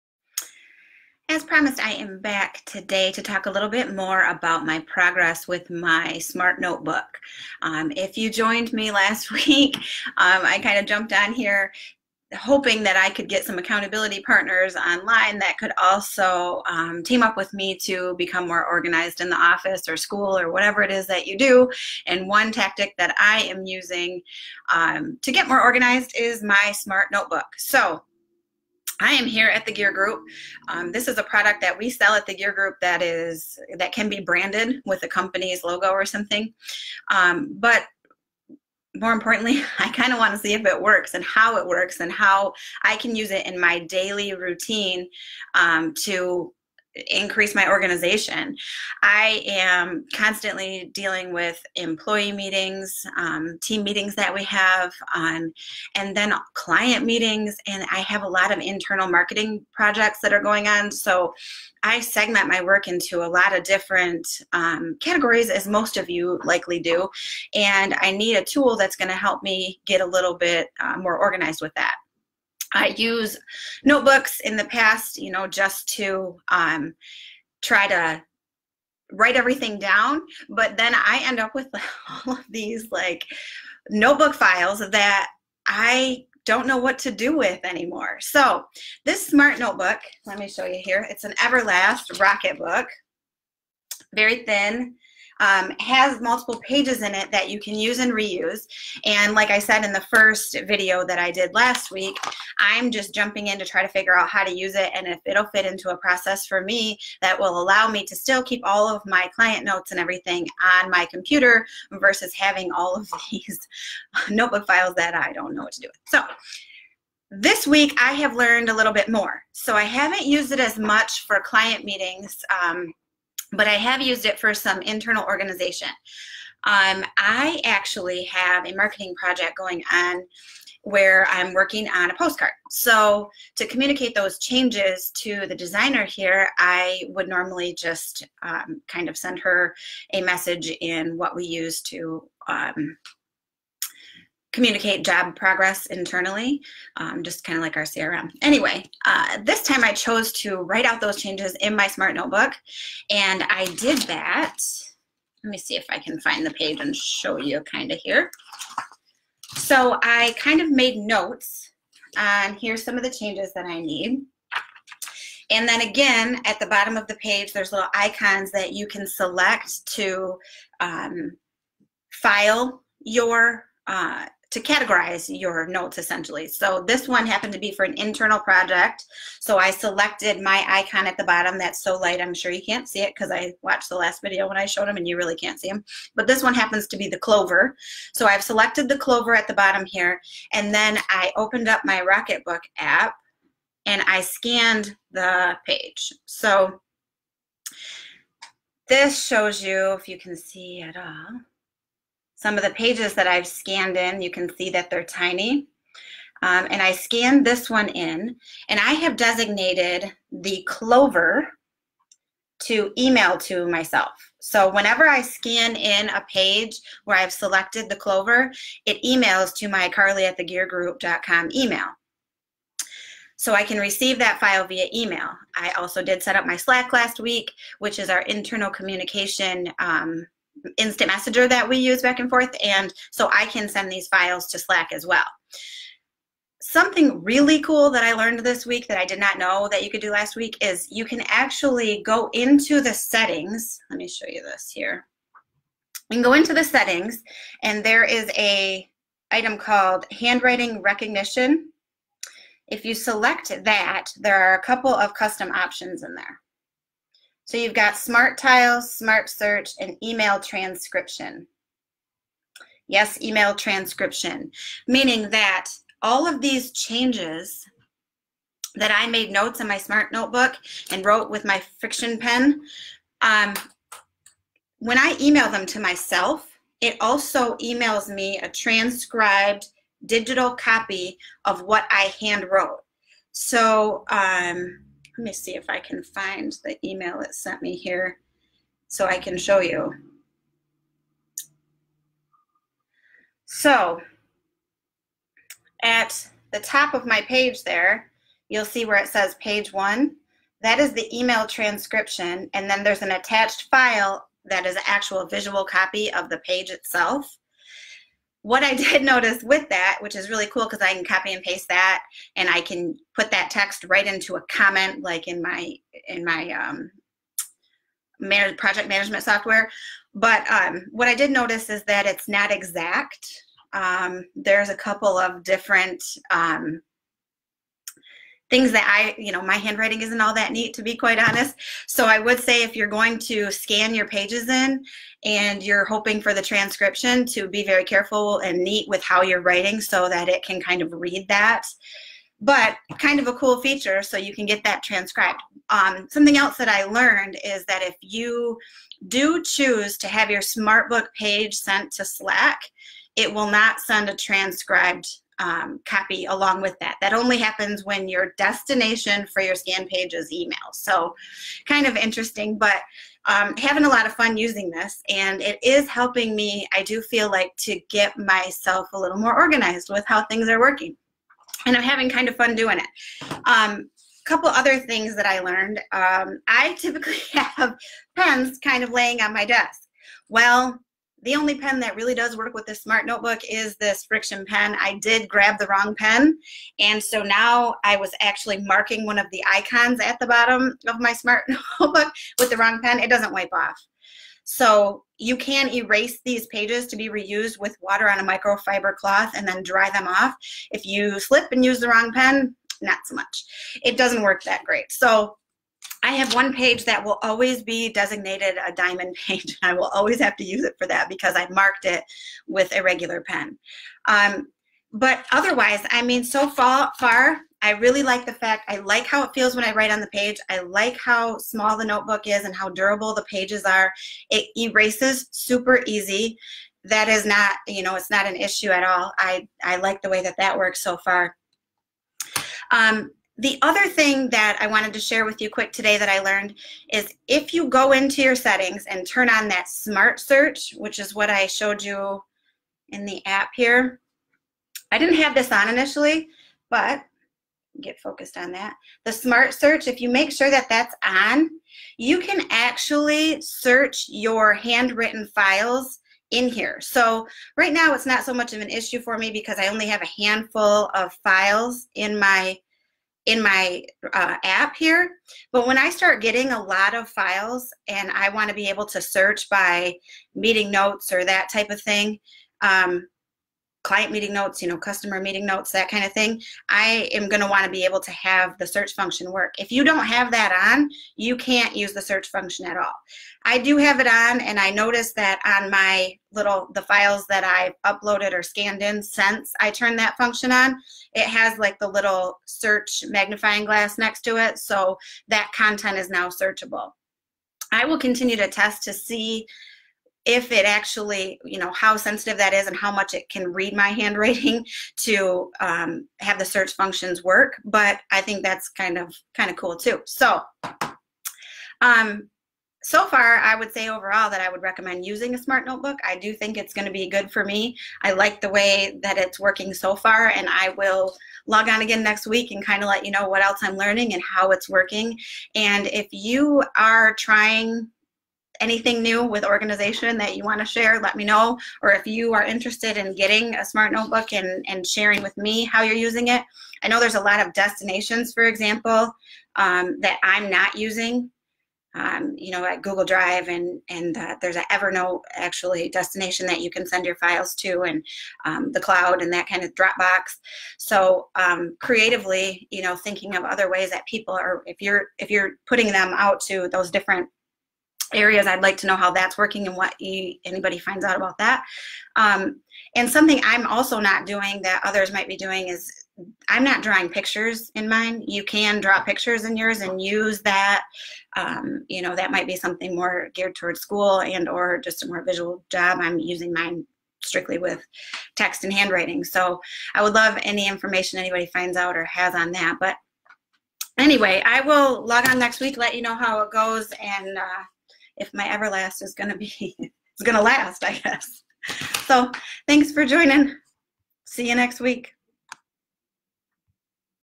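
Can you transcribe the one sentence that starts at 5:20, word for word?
But um, what I did notice is that it's not exact.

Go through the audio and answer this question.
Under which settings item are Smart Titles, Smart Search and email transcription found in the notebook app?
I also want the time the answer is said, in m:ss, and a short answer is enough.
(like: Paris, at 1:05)
handwriting recognition, at 4:10.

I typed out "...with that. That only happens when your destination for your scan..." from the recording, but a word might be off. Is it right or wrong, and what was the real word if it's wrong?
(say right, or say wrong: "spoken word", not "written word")
right.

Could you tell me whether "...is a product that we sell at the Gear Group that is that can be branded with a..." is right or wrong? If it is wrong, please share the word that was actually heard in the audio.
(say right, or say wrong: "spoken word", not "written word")
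right.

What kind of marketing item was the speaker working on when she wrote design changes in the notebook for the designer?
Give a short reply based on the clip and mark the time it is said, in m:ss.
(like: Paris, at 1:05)
a postcard, at 2:12.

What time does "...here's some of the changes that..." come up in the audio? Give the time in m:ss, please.
2:42.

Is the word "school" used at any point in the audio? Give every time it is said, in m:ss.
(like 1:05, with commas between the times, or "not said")
0:19, 9:33.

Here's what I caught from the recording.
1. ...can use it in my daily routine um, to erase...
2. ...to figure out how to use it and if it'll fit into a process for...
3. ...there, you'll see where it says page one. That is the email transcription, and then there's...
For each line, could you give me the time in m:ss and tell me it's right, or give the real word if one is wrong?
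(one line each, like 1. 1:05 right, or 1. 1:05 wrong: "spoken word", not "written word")
1. 0:42 wrong: "increase", not "erase"
2. 1:43 right
3. 4:57 right.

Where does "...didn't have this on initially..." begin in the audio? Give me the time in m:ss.
7:24.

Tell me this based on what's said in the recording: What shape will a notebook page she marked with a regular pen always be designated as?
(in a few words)
diamond.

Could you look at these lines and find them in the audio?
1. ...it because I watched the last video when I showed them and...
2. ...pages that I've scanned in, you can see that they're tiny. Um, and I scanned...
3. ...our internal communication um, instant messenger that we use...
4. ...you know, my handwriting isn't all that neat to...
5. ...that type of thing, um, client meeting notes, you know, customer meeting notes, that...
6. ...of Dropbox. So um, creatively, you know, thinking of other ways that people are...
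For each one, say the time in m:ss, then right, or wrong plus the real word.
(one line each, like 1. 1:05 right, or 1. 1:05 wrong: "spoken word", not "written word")
1. 3:02 right
2. 3:22 right
3. 3:48 right
4. 5:29 right
5. 7:51 right
6. 9:09 right.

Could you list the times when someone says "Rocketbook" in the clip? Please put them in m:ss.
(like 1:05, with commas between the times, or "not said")
1:32, 3:12.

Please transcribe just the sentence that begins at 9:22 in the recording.
Um, and something I'm also not doing that others might be doing is I'm not drawing pictures in mine.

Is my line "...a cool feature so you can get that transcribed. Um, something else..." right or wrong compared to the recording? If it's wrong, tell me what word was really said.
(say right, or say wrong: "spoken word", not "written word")
right.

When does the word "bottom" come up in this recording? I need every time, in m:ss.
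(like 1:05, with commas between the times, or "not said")
2:46, 3:01, 3:09, 6:30.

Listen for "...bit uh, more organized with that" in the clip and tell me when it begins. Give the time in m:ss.
1:10.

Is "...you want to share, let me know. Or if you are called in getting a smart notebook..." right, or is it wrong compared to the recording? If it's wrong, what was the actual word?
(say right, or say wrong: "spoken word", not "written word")
wrong: "interested", not "called".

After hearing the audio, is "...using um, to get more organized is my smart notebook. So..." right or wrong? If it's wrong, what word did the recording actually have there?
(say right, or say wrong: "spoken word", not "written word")
right.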